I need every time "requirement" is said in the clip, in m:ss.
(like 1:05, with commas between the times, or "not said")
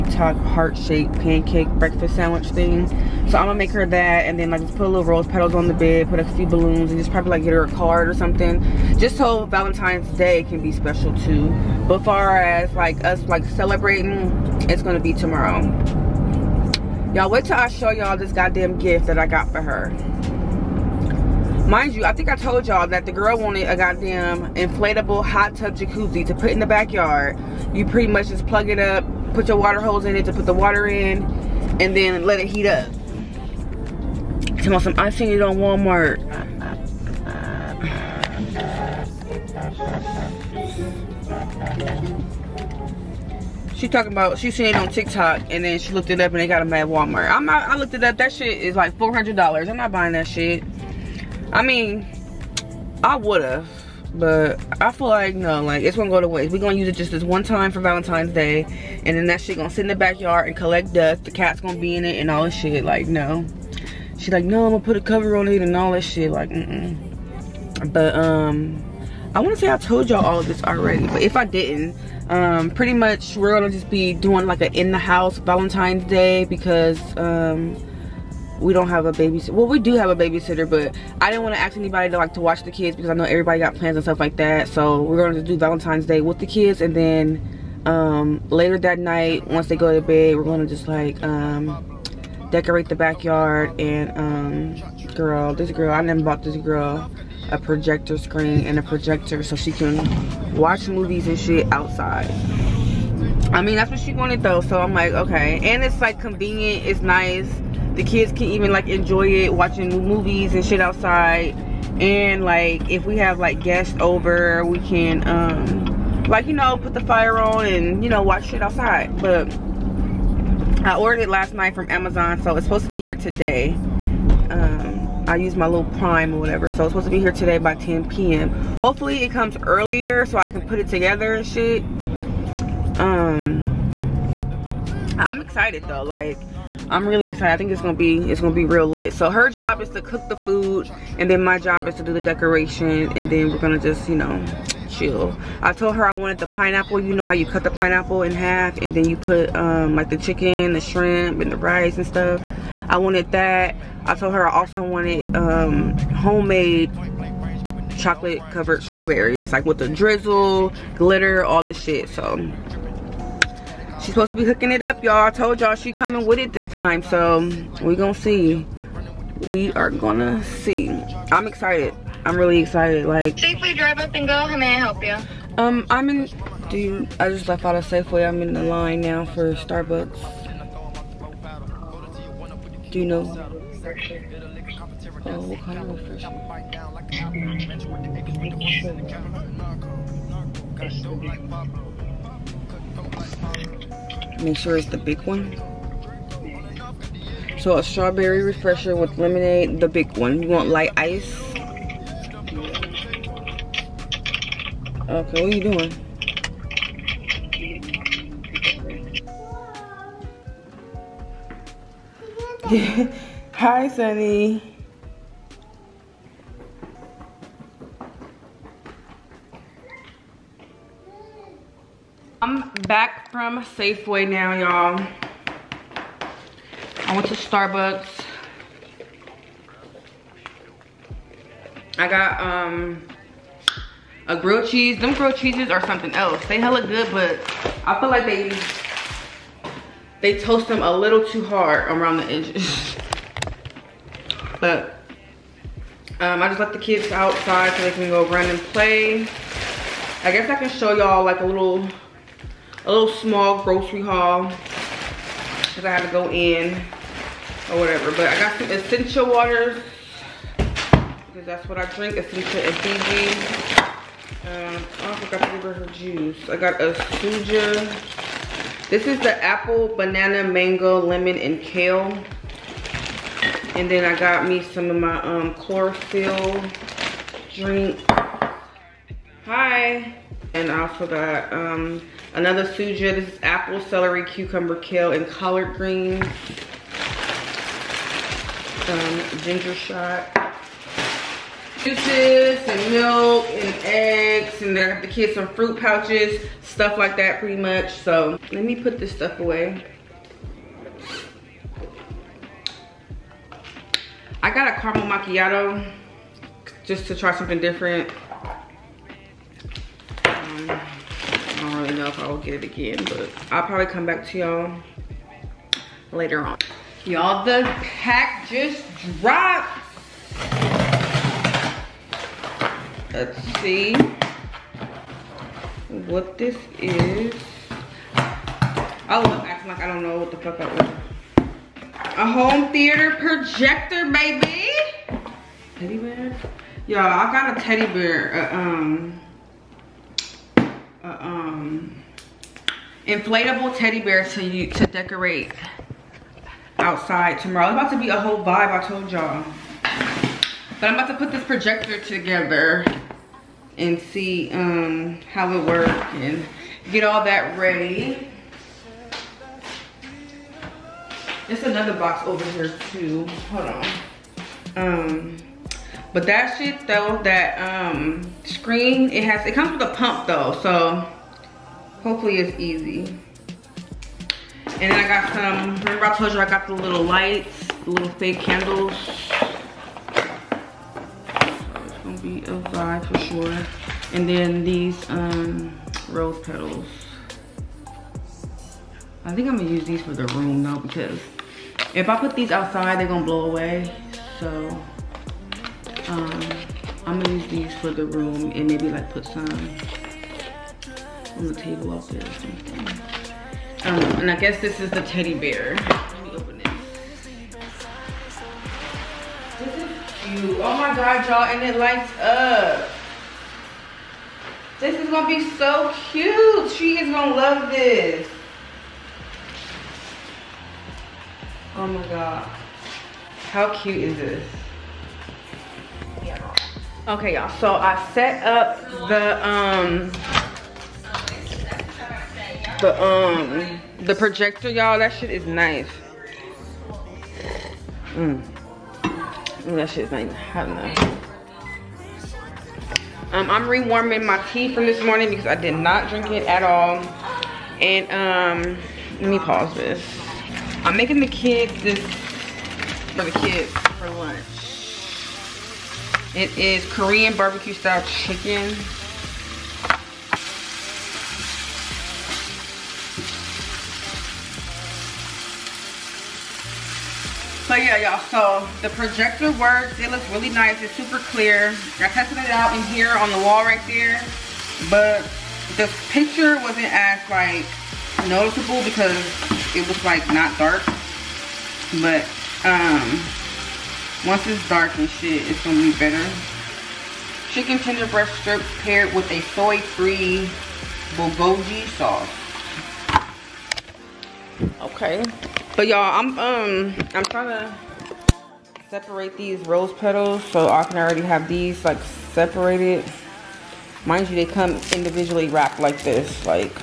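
not said.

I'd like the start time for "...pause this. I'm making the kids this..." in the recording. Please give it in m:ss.
7:29.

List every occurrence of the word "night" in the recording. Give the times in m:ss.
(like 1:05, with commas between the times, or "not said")
1:28, 2:01.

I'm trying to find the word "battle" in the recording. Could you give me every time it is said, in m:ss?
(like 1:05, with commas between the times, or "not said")
not said.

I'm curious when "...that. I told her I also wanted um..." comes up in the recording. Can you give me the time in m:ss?
2:33.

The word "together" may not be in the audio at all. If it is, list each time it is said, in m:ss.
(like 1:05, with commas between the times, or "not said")
2:10, 5:52.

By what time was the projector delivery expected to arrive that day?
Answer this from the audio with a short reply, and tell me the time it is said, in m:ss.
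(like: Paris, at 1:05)
10 p.m., at 2:07.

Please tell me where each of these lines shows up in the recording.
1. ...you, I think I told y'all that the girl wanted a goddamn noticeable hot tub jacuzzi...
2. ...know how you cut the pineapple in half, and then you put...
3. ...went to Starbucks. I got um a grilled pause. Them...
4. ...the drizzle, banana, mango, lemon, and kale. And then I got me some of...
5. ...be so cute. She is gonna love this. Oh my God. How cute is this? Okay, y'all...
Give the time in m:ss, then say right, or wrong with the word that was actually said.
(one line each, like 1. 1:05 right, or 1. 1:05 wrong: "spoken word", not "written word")
1. 0:21 wrong: "inflatable", not "noticeable"
2. 2:27 right
3. 3:47 wrong: "cheese", not "pause"
4. 4:29 wrong: "apple", not "drizzle"
5. 6:55 right.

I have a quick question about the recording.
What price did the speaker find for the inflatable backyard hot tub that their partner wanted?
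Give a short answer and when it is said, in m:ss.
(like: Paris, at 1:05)
$400, at 0:48.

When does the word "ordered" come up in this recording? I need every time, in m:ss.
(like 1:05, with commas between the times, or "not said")
2:00, 5:30.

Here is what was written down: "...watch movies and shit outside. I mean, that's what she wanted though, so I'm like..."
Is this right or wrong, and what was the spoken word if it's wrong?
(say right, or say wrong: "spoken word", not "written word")
right.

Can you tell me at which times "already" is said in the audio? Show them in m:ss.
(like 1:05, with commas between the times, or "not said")
1:10, 8:20.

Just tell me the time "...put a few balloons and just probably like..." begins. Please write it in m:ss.
0:06.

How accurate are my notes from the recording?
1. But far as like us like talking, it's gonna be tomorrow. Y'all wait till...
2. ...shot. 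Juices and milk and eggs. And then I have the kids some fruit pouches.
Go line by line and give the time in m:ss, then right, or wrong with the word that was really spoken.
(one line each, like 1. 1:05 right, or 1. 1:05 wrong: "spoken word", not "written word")
1. 0:11 wrong: "celebrating", not "talking"
2. 4:49 right.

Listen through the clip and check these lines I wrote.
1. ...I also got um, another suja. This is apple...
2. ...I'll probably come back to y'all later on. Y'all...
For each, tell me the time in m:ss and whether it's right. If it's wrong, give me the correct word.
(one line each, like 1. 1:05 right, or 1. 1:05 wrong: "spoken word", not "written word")
1. 4:40 right
2. 5:13 right.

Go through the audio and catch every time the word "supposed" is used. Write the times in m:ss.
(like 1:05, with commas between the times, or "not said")
2:02, 2:06, 2:44.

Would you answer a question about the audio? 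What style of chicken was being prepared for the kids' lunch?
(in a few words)
Korean barbecue.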